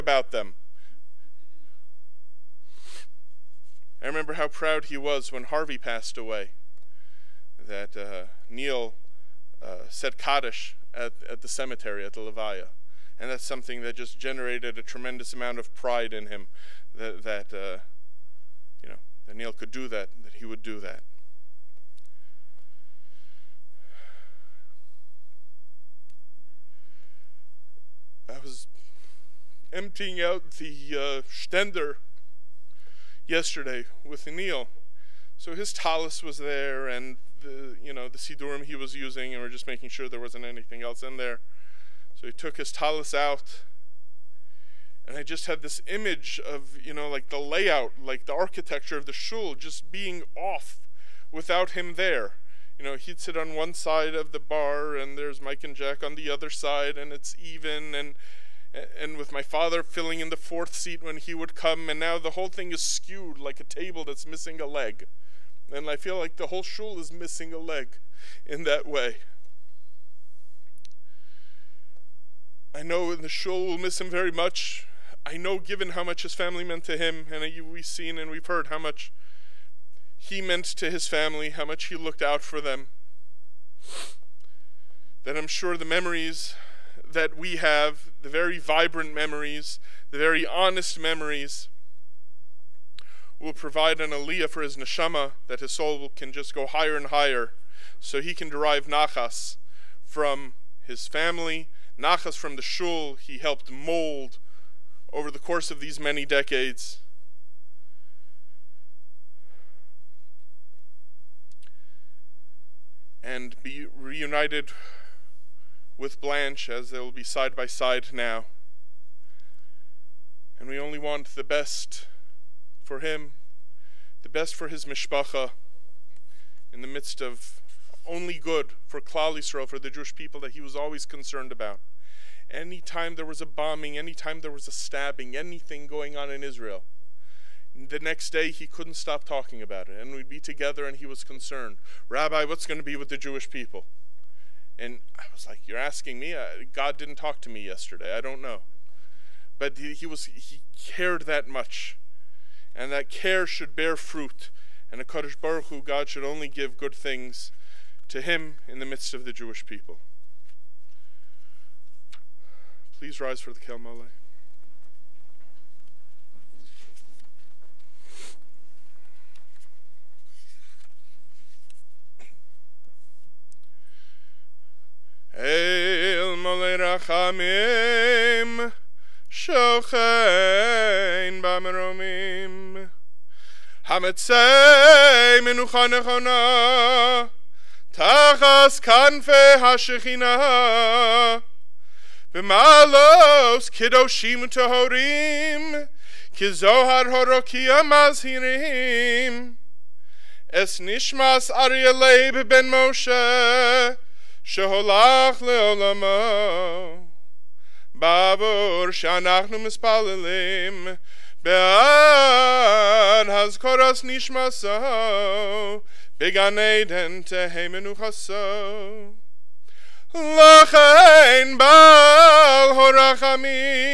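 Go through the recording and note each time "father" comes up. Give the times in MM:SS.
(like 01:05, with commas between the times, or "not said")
00:59.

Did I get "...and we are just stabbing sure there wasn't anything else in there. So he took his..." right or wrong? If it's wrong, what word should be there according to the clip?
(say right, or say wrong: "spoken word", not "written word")
wrong: "making", not "stabbing".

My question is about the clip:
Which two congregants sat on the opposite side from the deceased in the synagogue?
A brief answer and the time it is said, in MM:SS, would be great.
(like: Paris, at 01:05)
Mike and Jack, at 00:55.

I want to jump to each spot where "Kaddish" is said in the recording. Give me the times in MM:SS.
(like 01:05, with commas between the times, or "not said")
00:10, 02:35.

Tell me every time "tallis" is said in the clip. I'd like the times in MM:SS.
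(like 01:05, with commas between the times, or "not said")
00:35, 00:42.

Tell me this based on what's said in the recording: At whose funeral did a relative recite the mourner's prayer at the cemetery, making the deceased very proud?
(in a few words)
Harvey.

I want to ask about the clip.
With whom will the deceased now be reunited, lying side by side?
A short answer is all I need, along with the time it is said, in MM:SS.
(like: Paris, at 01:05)
Blanche, at 01:56.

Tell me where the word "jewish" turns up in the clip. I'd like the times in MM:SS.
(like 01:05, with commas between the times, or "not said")
02:09, 02:23, 02:39.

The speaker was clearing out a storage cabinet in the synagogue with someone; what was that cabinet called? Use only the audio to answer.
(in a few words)
Stender.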